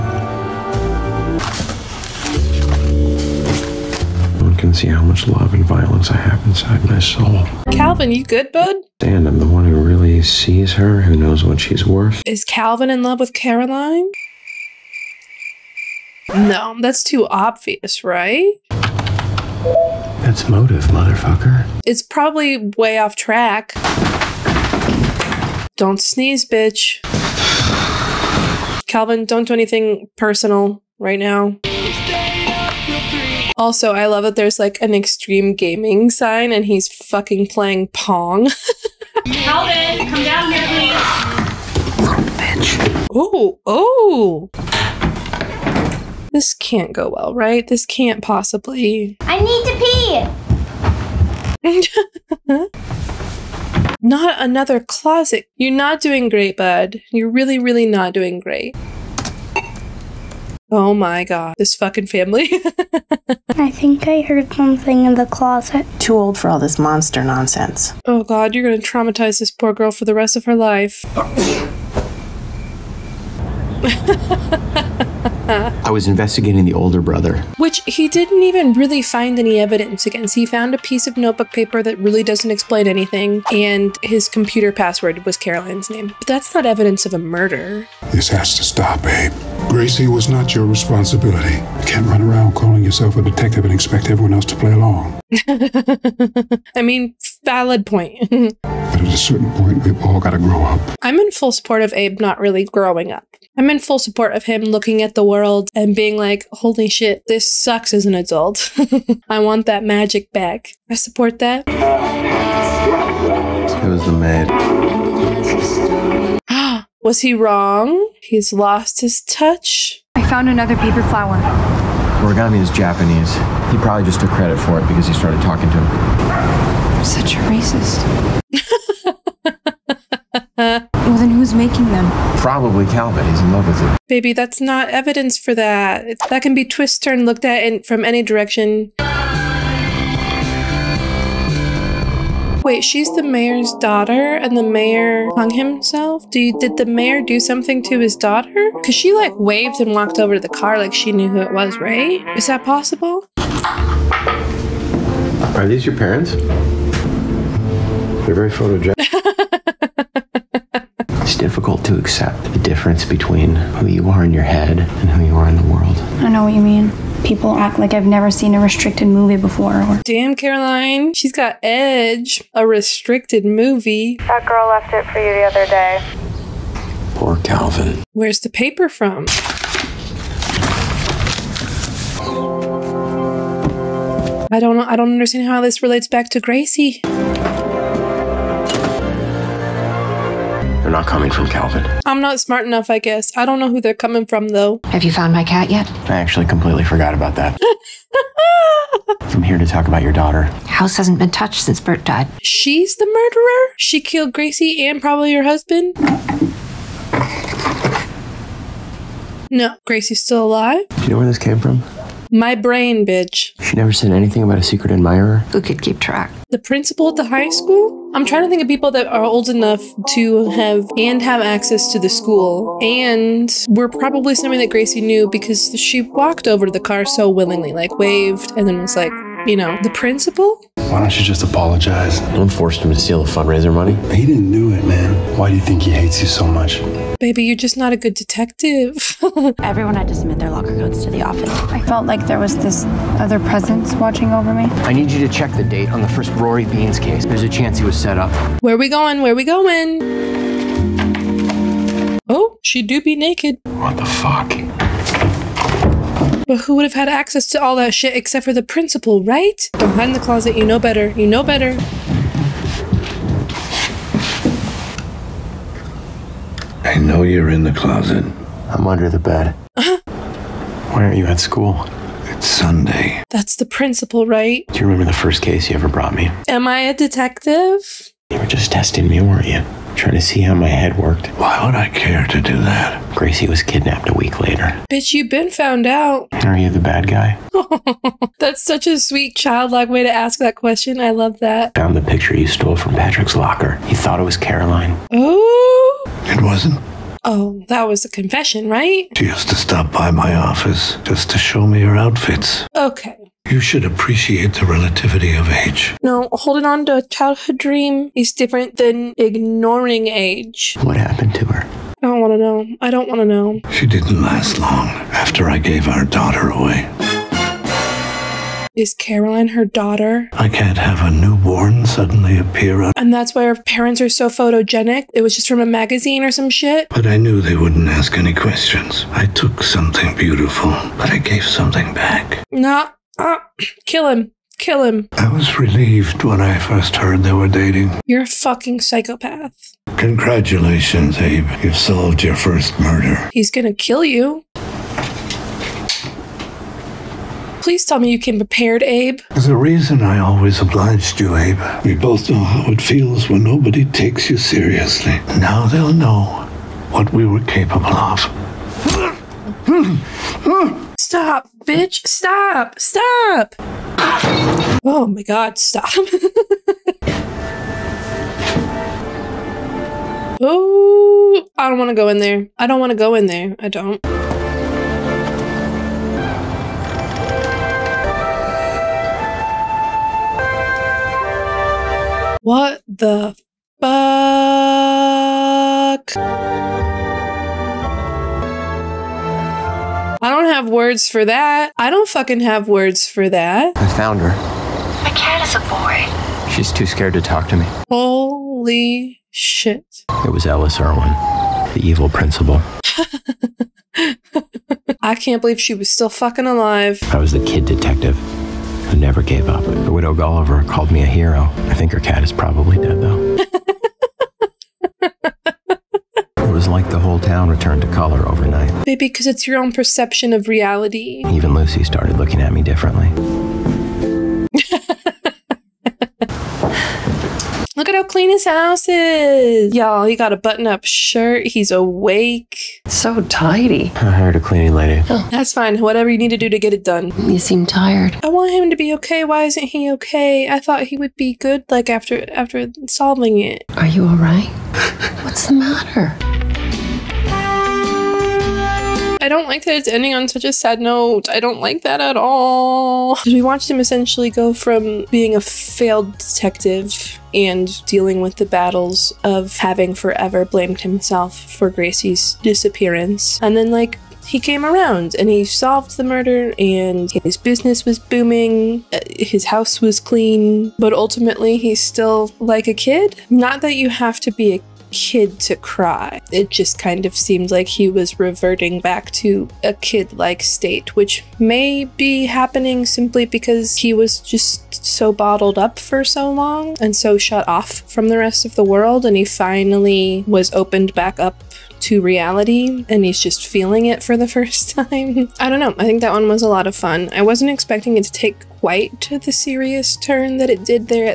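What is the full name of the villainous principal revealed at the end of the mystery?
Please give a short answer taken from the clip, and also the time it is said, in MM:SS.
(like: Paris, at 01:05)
Alice Irwin, at 06:40.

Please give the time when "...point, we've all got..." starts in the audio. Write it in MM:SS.
01:39.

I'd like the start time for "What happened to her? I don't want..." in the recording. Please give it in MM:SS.
05:10.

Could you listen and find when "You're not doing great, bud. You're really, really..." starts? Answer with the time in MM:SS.
00:55.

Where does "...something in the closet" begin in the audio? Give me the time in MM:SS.
01:04.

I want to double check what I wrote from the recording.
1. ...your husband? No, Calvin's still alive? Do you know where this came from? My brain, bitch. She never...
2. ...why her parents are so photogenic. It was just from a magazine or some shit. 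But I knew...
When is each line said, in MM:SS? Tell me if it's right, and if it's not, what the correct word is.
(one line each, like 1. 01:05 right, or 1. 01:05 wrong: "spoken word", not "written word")
1. 03:25 wrong: "Gracie", not "Calvin"
2. 05:23 right.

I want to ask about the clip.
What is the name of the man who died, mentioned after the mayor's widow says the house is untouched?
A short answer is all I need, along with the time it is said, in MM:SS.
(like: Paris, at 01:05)
Bert, at 03:21.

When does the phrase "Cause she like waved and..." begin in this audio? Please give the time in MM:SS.
02:28.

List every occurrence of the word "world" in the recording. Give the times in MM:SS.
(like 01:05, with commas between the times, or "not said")
01:45, 02:45, 08:08.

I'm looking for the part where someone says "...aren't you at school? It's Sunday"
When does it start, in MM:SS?
04:31.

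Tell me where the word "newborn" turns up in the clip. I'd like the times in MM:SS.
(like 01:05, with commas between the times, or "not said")
05:21.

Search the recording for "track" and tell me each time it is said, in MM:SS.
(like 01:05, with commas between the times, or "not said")
00:23, 03:35.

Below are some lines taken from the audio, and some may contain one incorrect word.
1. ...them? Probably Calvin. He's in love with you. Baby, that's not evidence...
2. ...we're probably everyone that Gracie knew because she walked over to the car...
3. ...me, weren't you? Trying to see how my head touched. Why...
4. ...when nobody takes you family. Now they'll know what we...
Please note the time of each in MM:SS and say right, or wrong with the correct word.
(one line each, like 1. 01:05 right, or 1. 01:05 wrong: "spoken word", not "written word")
1. 02:11 right
2. 03:43 wrong: "someone", not "everyone"
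3. 04:39 wrong: "worked", not "touched"
4. 05:53 wrong: "seriously", not "family".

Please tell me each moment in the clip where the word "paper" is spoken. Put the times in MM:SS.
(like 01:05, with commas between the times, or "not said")
01:21, 02:00, 02:58.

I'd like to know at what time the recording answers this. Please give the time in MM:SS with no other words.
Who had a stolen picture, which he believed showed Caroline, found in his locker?
04:52.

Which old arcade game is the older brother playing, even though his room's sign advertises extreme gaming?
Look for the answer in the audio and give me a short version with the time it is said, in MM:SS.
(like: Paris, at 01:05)
Pong, at 00:37.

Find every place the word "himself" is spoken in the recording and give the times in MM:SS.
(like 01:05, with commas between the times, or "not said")
02:25, 07:40.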